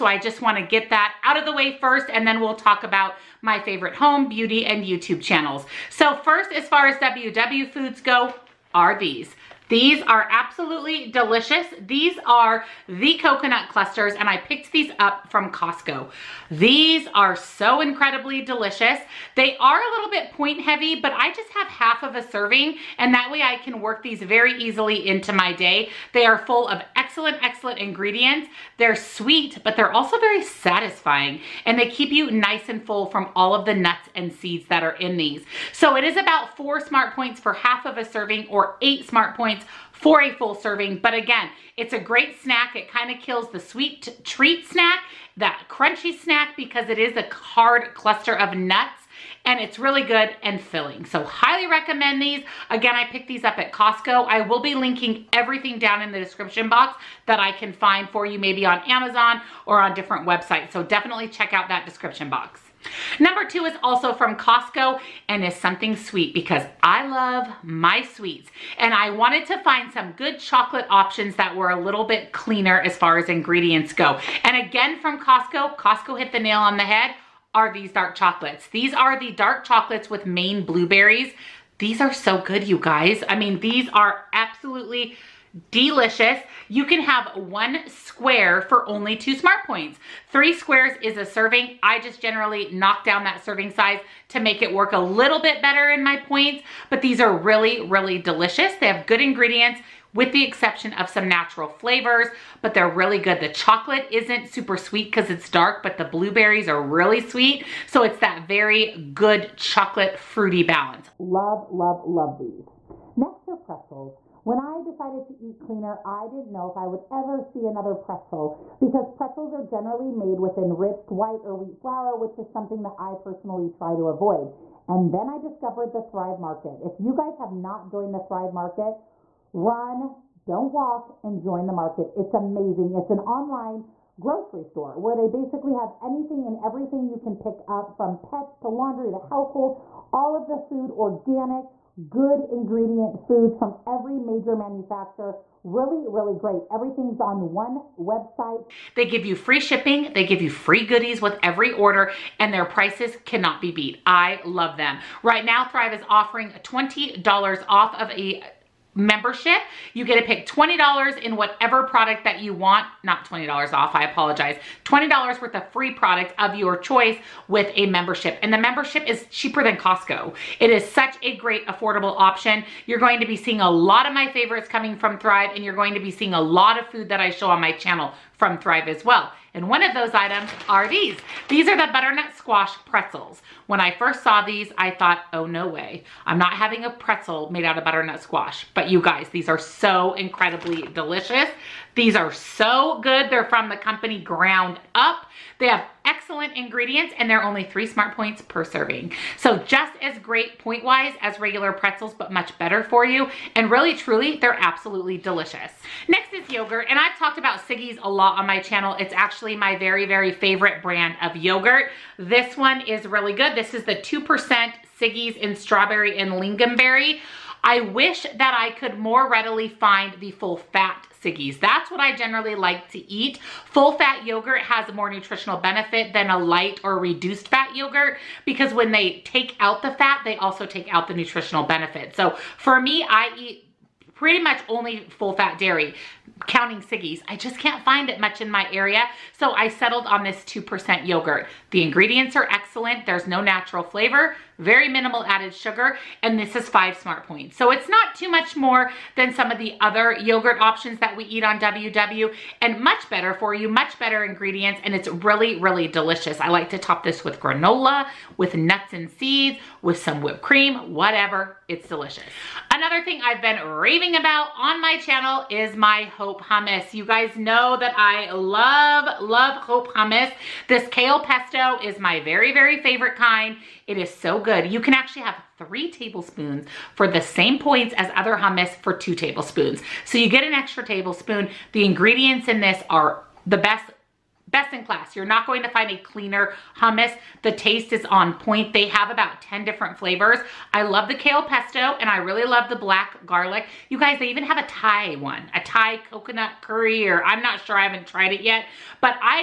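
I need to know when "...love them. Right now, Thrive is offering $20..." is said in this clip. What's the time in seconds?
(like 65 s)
154 s.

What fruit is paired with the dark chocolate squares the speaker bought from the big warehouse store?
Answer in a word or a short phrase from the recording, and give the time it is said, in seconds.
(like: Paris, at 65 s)
Maine blueberries, at 80 s.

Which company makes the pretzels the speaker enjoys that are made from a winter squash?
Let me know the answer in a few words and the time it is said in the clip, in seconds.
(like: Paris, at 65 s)
Ground Up, at 194 s.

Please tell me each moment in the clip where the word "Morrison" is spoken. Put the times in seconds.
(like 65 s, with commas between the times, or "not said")
not said.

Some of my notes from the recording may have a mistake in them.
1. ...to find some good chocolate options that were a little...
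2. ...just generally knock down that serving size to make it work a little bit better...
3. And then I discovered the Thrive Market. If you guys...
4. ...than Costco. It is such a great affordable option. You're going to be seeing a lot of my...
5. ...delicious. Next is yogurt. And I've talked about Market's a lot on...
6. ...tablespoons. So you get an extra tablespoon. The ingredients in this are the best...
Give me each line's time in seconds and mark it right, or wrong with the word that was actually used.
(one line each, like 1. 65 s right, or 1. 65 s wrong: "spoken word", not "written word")
1. 69 s right
2. 91 s right
3. 124 s right
4. 169 s right
5. 205 s wrong: "Siggi", not "Market"
6. 279 s right.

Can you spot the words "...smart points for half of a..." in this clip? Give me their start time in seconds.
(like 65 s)
36 s.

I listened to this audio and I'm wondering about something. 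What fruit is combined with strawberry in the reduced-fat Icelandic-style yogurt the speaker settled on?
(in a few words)
lingonberry.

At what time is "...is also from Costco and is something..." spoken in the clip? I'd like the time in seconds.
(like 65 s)
63 s.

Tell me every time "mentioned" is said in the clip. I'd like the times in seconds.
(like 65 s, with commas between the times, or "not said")
not said.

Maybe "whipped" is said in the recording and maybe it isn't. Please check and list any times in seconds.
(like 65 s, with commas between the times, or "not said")
260 s.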